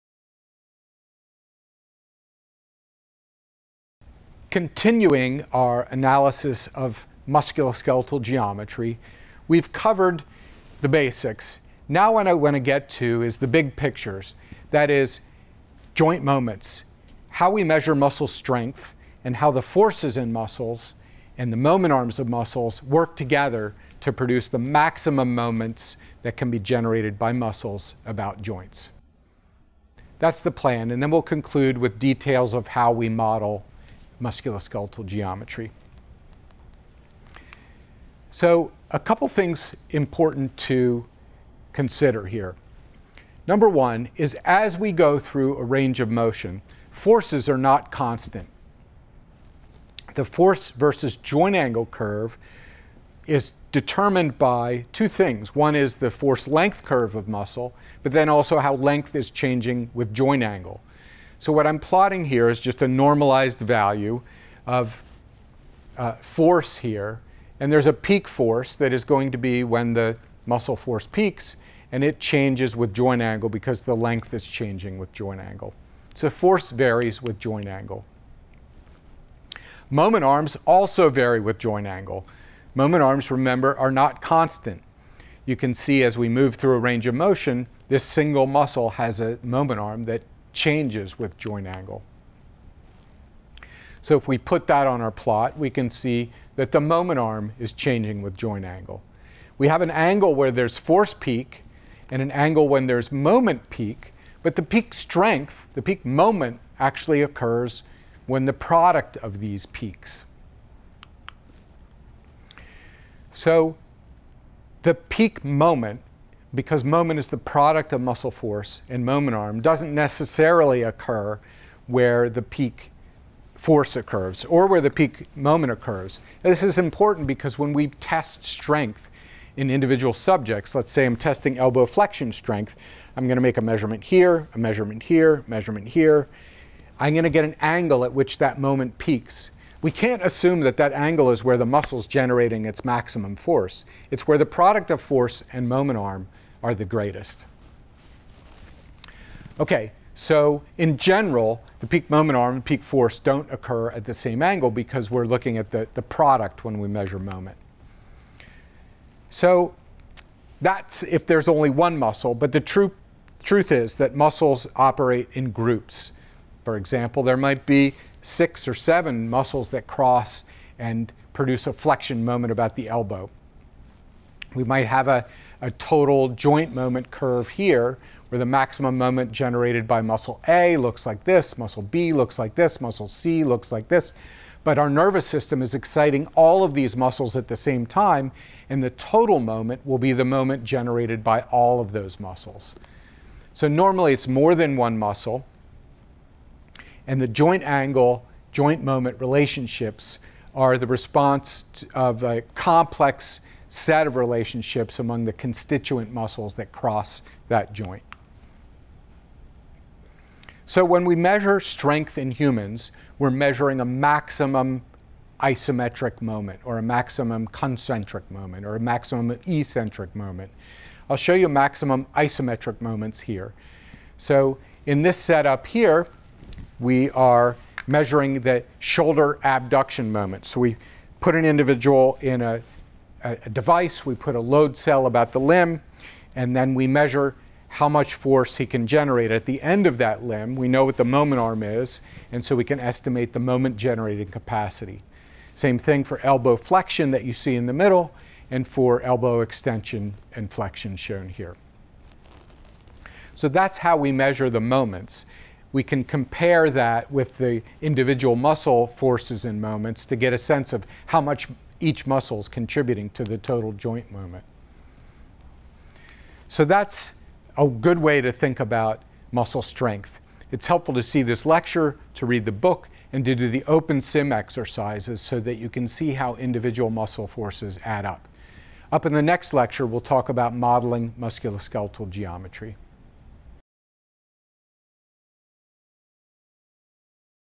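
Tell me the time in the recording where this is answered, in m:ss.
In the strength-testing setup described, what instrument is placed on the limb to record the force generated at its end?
3:54.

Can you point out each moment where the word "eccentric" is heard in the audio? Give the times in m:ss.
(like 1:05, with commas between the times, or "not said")
3:39.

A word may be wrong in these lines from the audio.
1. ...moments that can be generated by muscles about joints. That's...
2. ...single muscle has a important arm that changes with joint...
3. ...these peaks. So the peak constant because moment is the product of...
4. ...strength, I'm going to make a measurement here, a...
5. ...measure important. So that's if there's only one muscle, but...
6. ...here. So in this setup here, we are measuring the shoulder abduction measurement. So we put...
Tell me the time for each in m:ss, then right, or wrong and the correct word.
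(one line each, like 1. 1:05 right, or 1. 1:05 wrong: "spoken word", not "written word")
1. 0:25 right
2. 1:28 wrong: "moment", not "important"
3. 1:49 wrong: "moment", not "constant"
4. 2:12 right
5. 2:36 wrong: "moment", not "important"
6. 3:43 wrong: "moment", not "measurement".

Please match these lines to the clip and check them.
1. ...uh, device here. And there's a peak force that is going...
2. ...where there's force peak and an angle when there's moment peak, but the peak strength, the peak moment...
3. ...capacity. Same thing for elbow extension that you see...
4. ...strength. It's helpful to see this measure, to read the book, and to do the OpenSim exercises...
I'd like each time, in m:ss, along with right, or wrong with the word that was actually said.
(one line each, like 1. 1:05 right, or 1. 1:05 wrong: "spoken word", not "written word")
1. 1:05 wrong: "force", not "device"
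2. 1:40 right
3. 4:04 wrong: "flexion", not "extension"
4. 4:29 wrong: "lecture", not "measure".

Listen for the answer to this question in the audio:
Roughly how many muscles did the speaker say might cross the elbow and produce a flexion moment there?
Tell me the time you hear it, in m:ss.
2:48.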